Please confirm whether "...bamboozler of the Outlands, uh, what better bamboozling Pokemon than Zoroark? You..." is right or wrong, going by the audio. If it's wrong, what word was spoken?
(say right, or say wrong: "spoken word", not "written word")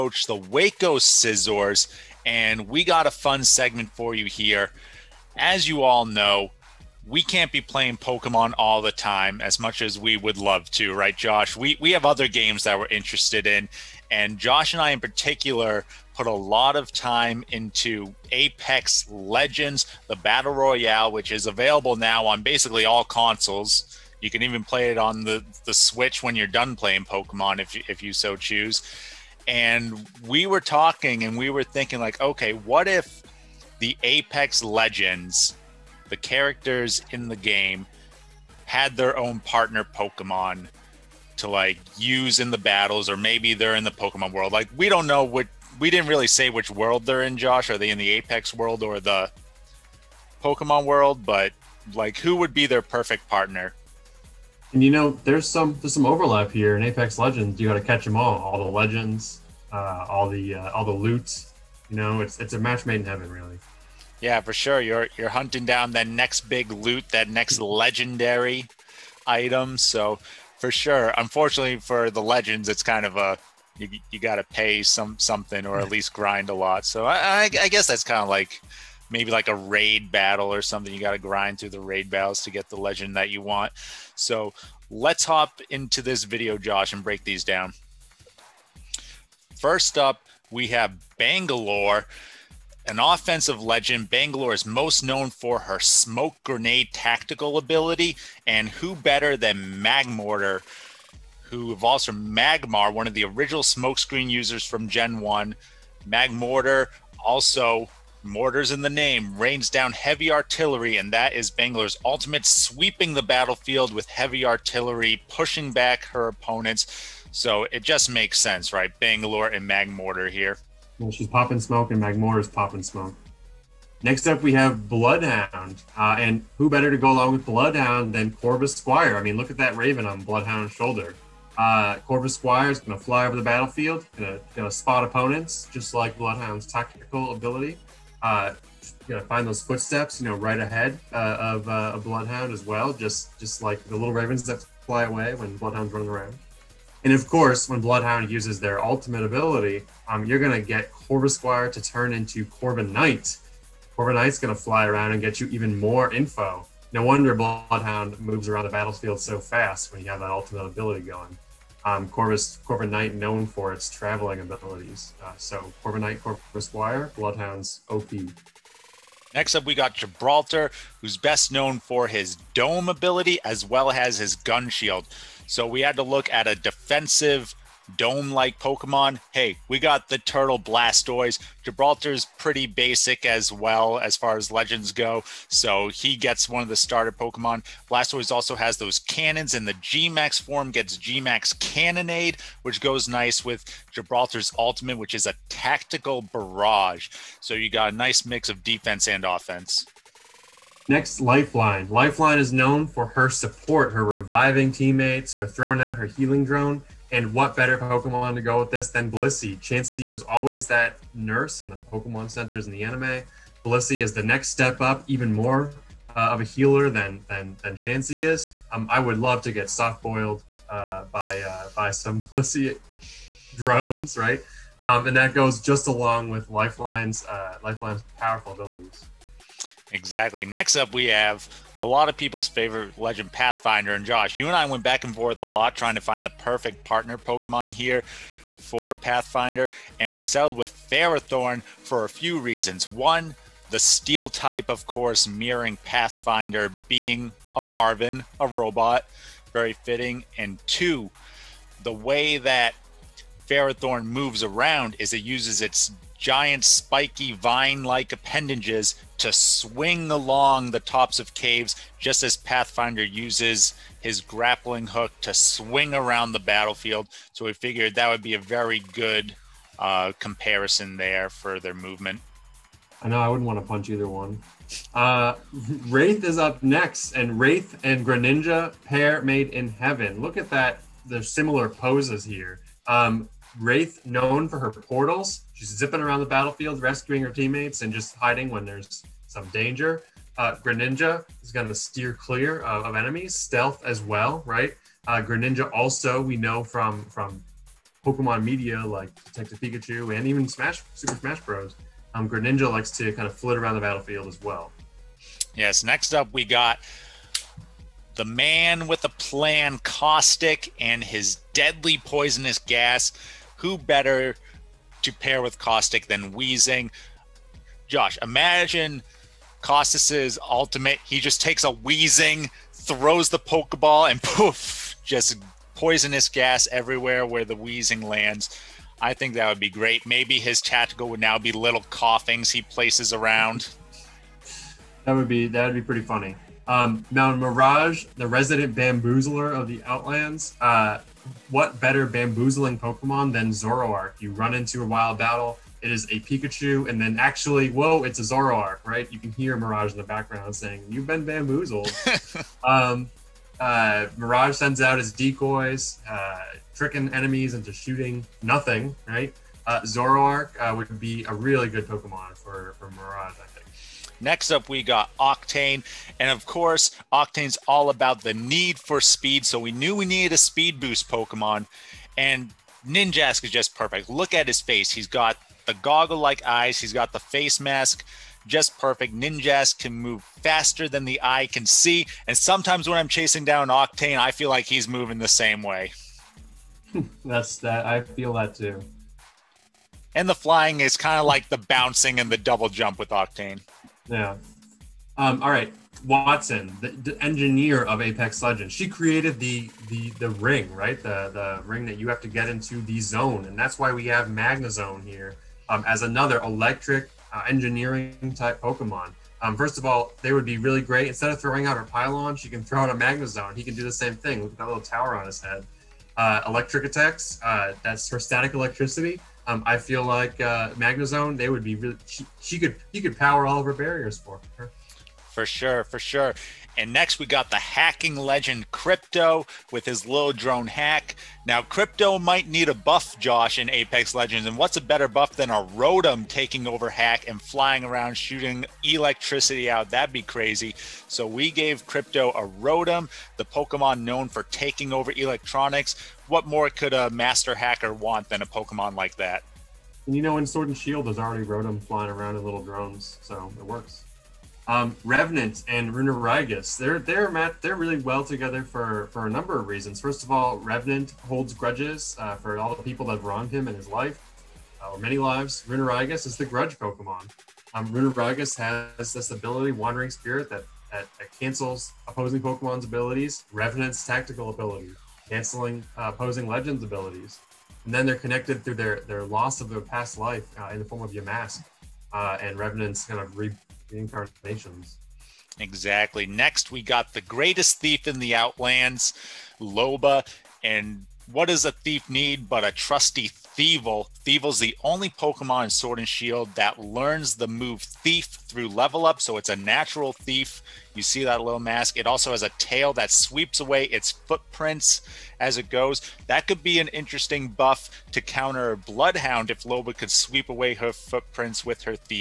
right.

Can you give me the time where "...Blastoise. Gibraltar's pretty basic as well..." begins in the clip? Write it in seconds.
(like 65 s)
180 s.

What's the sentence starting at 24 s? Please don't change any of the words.
You can even play it on the the Switch when you're done playing Pokemon if if you so choose.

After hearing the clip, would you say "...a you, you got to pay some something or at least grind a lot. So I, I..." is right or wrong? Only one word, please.
right.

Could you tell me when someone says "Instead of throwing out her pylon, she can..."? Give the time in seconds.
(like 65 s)
411 s.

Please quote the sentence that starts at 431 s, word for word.
Now, Crypto might need a buff, Josh, in Apex Legends.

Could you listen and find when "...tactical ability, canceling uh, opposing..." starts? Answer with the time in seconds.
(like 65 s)
474 s.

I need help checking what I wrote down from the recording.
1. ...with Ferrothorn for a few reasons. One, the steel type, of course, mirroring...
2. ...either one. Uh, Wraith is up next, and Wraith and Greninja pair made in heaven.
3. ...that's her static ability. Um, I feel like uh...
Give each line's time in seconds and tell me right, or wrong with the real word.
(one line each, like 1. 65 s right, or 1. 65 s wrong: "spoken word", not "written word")
1. 240 s right
2. 273 s right
3. 417 s wrong: "electricity", not "ability".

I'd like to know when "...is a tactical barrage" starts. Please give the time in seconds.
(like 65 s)
195 s.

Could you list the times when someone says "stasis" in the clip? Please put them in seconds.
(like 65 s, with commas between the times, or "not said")
not said.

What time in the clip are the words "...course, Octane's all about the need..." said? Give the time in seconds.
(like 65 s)
366 s.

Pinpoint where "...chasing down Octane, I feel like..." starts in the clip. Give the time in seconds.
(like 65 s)
383 s.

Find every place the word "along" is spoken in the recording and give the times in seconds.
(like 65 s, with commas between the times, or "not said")
127 s, 225 s, 260 s.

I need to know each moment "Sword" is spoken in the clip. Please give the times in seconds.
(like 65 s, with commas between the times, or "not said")
450 s, 495 s.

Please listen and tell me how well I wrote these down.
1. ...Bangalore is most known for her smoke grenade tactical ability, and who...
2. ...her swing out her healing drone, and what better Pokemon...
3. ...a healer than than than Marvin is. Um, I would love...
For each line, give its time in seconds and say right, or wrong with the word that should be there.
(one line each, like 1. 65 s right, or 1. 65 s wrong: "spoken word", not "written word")
1. 94 s right
2. 205 s wrong: "throwing", not "swing"
3. 216 s wrong: "Chansey", not "Marvin".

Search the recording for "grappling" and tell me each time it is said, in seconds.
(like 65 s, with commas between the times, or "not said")
264 s.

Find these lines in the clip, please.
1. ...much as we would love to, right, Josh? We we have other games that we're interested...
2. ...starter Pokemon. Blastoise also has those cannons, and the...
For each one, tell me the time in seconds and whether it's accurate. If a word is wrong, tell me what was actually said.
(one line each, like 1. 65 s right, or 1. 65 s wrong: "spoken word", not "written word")
1. 9 s right
2. 186 s right.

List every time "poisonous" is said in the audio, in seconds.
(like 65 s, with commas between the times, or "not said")
312 s, 325 s.